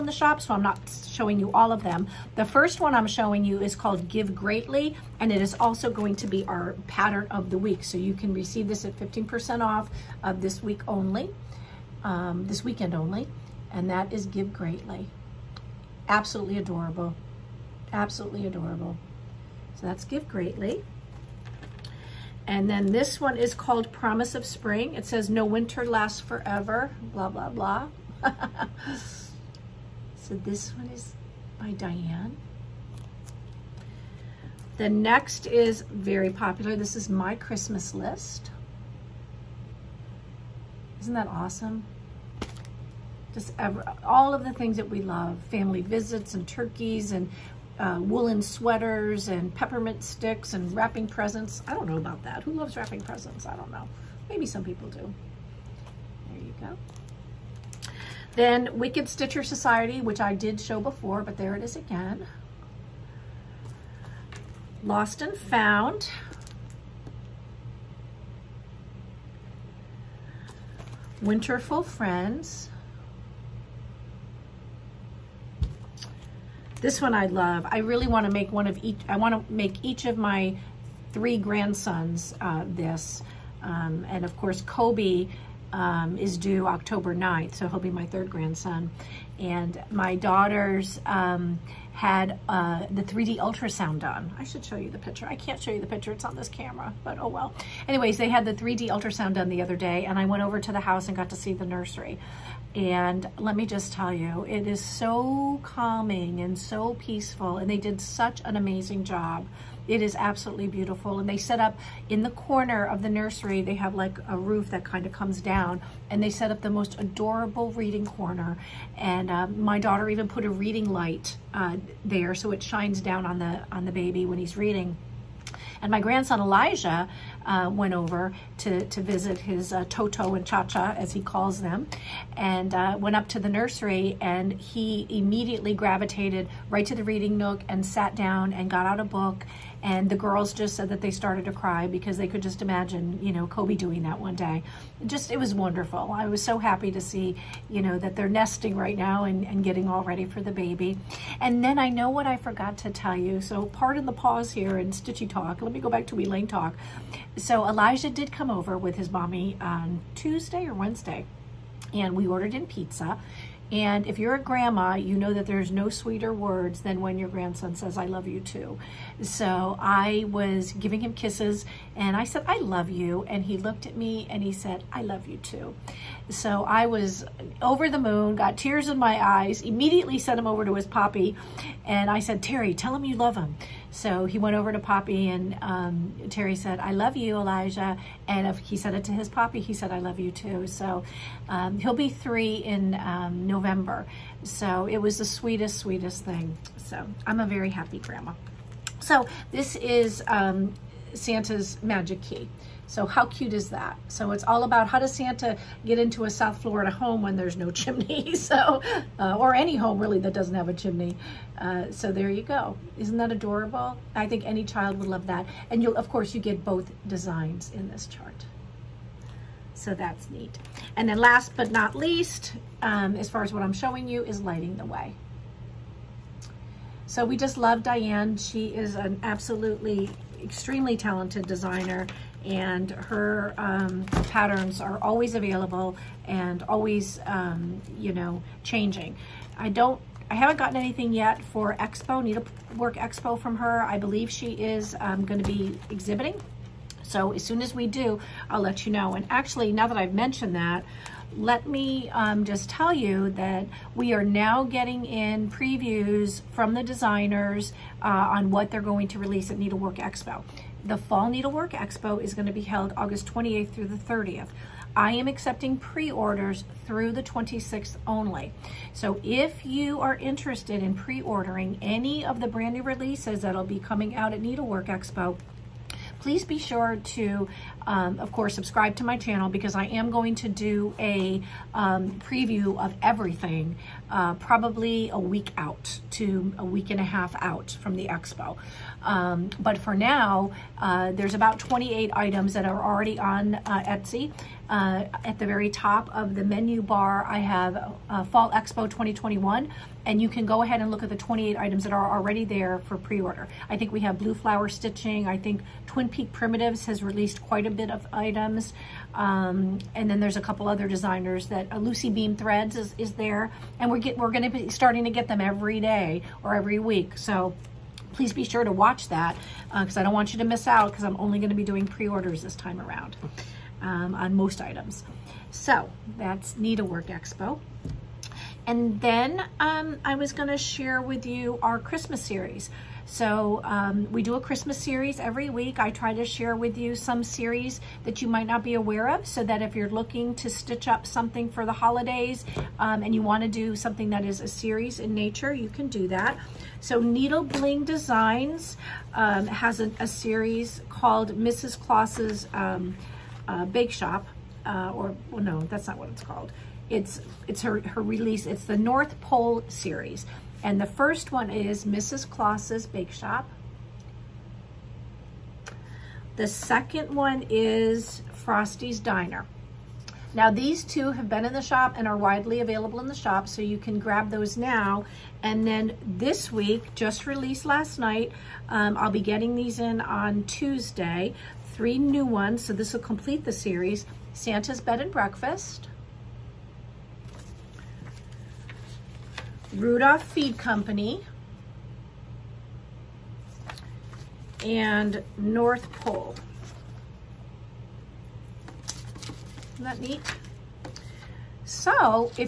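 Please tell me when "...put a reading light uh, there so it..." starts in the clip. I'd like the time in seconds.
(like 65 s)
120 s.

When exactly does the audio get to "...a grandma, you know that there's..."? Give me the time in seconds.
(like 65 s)
164 s.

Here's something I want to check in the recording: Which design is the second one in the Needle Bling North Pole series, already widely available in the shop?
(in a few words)
Frosty's Diner.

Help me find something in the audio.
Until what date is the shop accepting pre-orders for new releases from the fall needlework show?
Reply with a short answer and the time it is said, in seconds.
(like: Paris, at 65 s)
August 26th, at 267 s.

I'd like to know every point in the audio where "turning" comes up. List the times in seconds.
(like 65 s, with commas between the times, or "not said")
not said.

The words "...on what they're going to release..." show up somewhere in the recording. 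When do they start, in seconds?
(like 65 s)
258 s.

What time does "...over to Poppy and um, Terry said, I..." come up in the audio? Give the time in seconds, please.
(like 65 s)
184 s.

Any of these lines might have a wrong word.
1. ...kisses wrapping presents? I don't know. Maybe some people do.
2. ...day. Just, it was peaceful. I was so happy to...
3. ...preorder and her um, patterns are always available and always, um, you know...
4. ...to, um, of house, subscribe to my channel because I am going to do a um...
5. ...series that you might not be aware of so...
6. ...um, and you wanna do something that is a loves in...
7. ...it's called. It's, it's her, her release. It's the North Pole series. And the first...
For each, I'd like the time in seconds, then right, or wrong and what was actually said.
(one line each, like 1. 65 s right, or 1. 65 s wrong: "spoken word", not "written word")
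1. 52 s wrong: "loves", not "kisses"
2. 144 s wrong: "wonderful", not "peaceful"
3. 231 s wrong: "designer", not "preorder"
4. 277 s wrong: "course", not "house"
5. 337 s right
6. 342 s wrong: "series", not "loves"
7. 356 s right.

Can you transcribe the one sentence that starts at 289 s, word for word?
Um, but for now, uh, there's about 28 items that are already on uh, Etsy.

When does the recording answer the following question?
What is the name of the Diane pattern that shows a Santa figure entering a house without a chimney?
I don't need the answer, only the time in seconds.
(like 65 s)
201 s.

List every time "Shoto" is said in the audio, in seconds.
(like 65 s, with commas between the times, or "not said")
not said.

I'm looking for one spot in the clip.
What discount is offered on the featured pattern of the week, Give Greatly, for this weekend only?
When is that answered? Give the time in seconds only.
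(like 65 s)
8 s.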